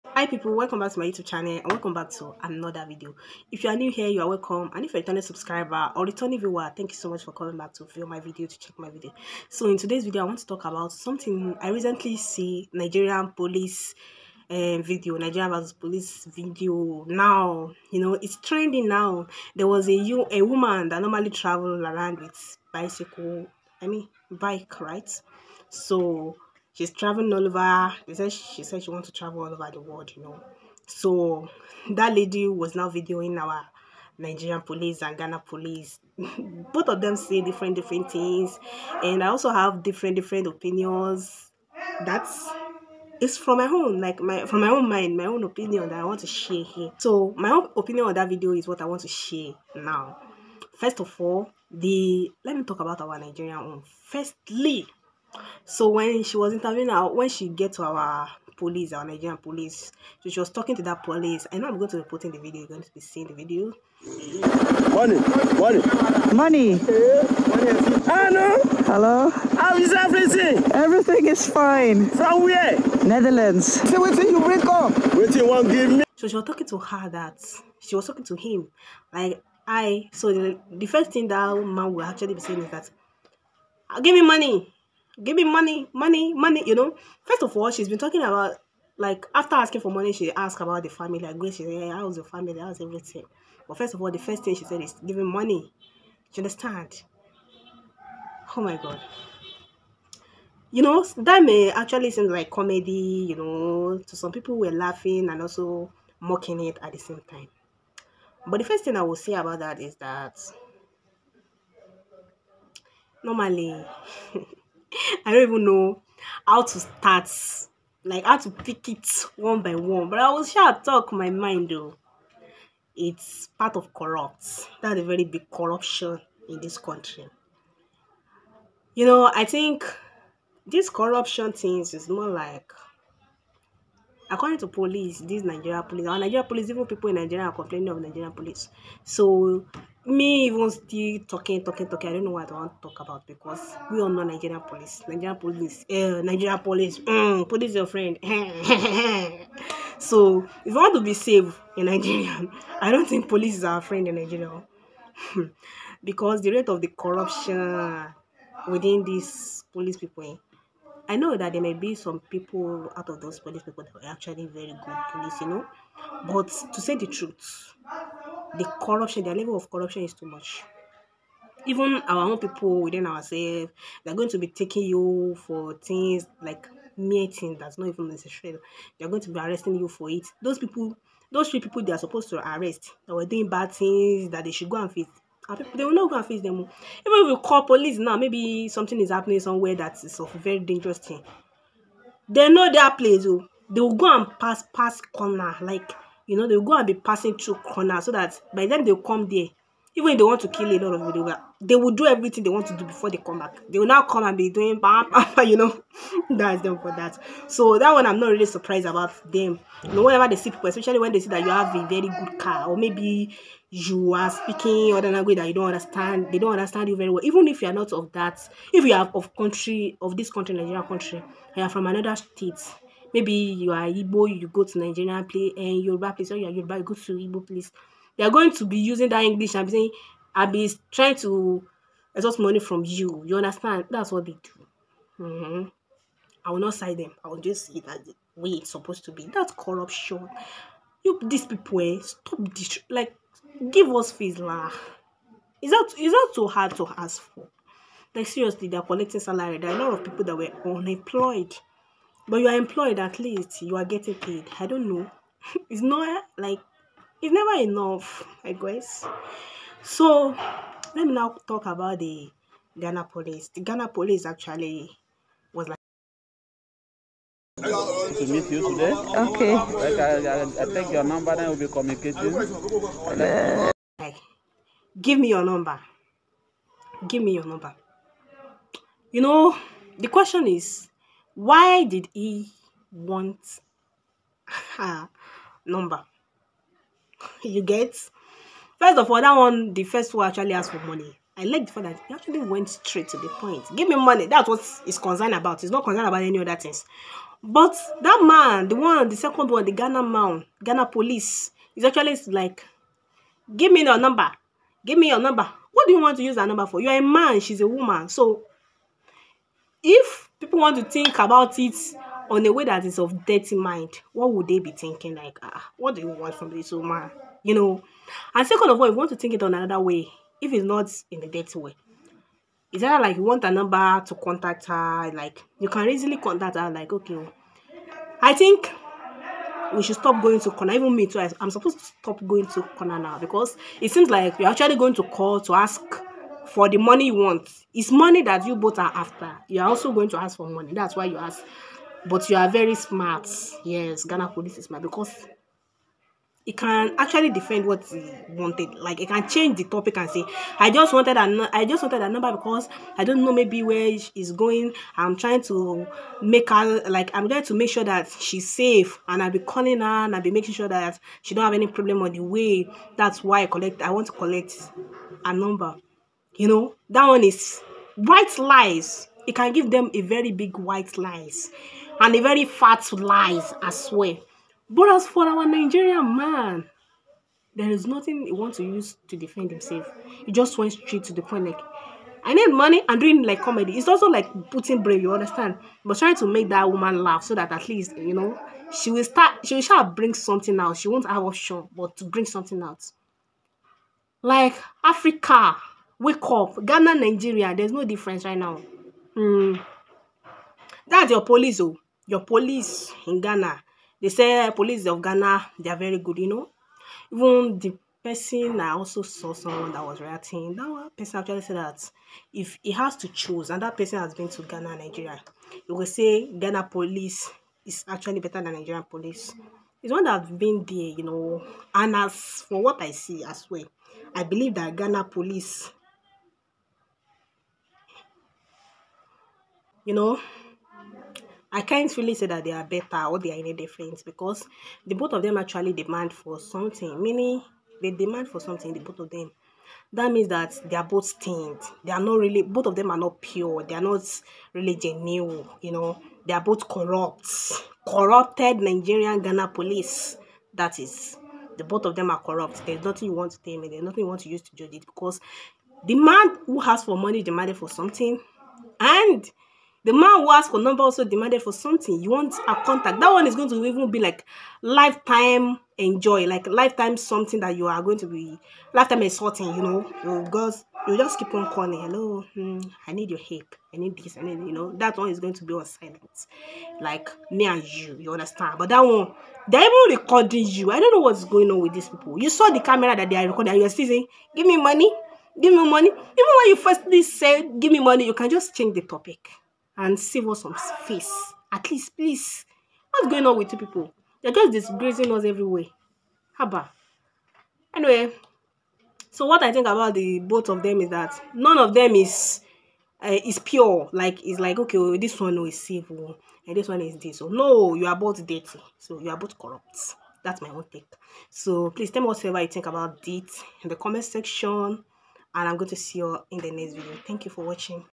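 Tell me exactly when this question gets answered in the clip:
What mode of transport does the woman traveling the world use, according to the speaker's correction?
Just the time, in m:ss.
0:24.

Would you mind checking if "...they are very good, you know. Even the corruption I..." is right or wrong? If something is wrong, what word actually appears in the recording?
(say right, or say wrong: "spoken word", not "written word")
wrong: "person", not "corruption".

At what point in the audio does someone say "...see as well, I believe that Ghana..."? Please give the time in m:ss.
7:02.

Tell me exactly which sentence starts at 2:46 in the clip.
But to say the truth, the corruption, the level of corruption is too much.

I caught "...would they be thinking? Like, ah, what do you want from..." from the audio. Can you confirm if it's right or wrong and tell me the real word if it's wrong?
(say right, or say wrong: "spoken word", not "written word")
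right.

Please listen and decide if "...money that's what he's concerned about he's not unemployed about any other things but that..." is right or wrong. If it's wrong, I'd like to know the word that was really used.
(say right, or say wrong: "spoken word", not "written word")
wrong: "concerned", not "unemployed".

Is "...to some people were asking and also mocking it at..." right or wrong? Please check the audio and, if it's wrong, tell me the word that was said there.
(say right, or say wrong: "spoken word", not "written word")
wrong: "laughing", not "asking".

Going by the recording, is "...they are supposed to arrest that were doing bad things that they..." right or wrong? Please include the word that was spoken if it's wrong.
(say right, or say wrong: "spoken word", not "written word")
right.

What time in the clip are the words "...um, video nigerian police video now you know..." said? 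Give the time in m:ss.
0:14.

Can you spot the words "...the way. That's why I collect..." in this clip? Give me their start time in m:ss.
6:02.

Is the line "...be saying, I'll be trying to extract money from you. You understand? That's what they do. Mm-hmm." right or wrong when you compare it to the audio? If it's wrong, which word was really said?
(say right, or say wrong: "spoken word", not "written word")
right.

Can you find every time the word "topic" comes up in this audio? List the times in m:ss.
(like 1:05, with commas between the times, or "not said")
5:49, 8:08.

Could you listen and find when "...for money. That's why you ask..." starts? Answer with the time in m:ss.
5:40.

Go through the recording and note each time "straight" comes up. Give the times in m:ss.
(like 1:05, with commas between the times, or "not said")
4:52, 6:20.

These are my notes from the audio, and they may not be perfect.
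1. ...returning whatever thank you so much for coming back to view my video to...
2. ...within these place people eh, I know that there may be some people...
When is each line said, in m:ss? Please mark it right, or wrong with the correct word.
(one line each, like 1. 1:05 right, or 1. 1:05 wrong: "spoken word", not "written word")
1. 0:06 wrong: "viewer", not "whatever"
2. 2:38 wrong: "police", not "place".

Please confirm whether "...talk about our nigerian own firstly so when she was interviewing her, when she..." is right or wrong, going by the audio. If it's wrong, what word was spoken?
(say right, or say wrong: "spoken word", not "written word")
right.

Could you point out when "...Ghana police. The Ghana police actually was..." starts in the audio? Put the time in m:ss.
4:22.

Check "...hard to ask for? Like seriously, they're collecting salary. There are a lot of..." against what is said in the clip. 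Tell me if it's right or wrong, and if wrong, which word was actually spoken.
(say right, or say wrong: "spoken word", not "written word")
right.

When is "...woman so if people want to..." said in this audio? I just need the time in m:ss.
5:07.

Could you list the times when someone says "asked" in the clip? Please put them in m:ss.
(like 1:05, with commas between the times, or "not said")
1:30, 4:50, 7:40.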